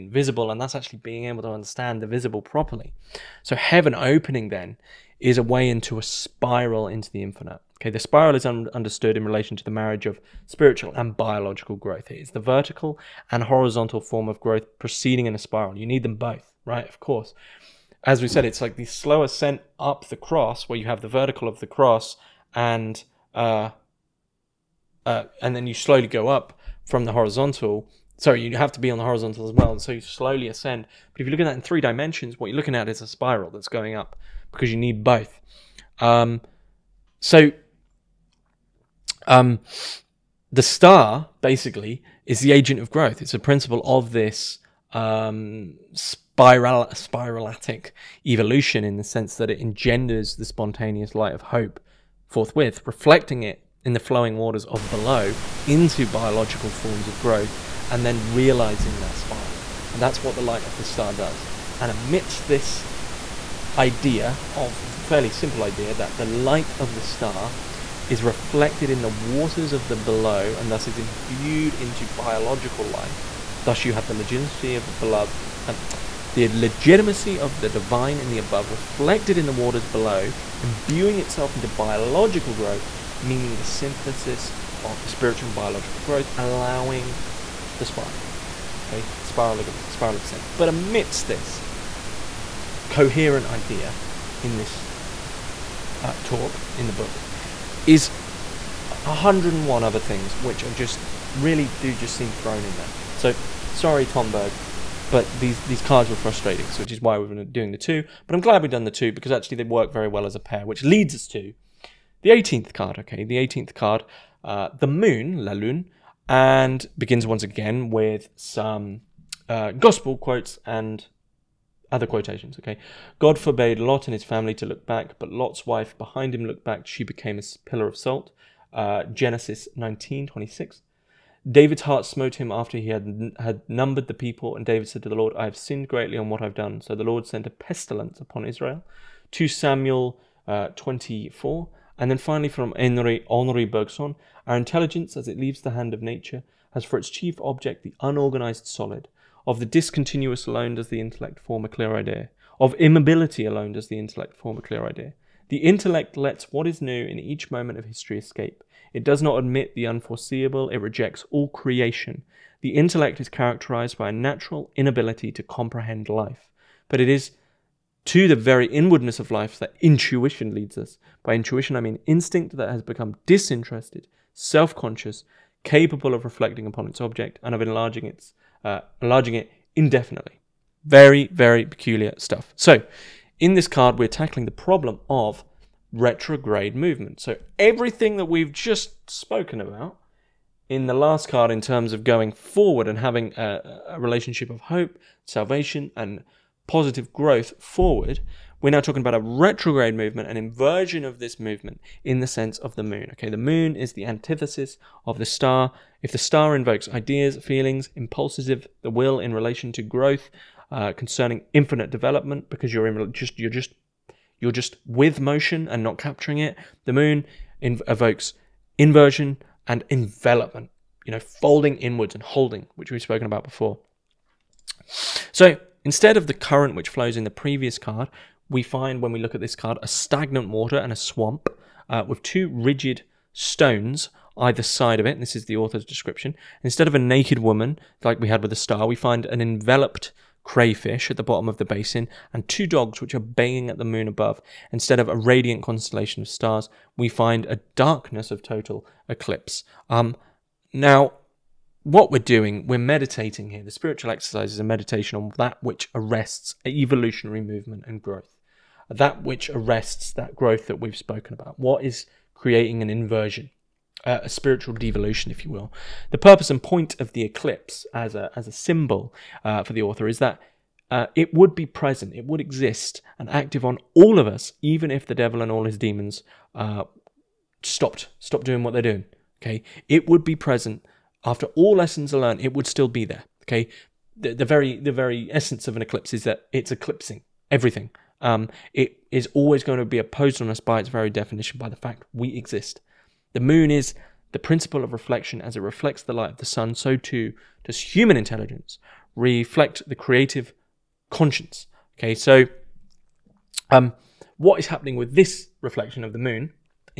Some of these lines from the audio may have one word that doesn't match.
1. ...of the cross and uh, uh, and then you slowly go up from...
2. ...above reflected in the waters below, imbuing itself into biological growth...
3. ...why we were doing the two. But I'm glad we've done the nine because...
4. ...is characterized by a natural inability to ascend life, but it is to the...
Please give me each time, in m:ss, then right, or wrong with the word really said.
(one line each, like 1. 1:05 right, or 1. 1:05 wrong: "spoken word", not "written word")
1. 0:21 right
2. 1:18 right
3. 1:47 wrong: "two", not "nine"
4. 2:43 wrong: "comprehend", not "ascend".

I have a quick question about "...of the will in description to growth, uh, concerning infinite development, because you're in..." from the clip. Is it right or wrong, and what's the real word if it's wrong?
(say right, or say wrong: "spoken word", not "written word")
wrong: "relation", not "description".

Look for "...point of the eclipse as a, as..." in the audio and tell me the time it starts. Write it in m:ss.
4:26.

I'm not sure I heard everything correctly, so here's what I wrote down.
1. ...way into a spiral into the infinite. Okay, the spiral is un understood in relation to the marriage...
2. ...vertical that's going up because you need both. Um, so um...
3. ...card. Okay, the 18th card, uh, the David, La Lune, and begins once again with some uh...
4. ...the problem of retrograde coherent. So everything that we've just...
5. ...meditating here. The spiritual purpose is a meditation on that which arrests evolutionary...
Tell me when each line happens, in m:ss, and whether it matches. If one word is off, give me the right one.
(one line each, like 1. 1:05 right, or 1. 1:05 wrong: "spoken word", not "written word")
1. 0:05 right
2. 0:33 wrong: "spiral", not "vertical"
3. 1:52 wrong: "Moon", not "David"
4. 3:04 wrong: "movement", not "coherent"
5. 4:12 wrong: "exercise", not "purpose".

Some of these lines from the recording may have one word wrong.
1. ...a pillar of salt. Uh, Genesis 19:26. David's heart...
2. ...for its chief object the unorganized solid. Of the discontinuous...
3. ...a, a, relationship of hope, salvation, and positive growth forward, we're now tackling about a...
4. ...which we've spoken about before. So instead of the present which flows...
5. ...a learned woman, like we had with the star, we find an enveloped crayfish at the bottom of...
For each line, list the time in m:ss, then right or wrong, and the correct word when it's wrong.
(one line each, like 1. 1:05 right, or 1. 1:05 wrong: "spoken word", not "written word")
1. 2:07 right
2. 2:26 right
3. 3:13 wrong: "talking", not "tackling"
4. 3:42 wrong: "current", not "present"
5. 3:56 wrong: "naked", not "learned".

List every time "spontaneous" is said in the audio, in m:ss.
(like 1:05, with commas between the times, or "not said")
0:50.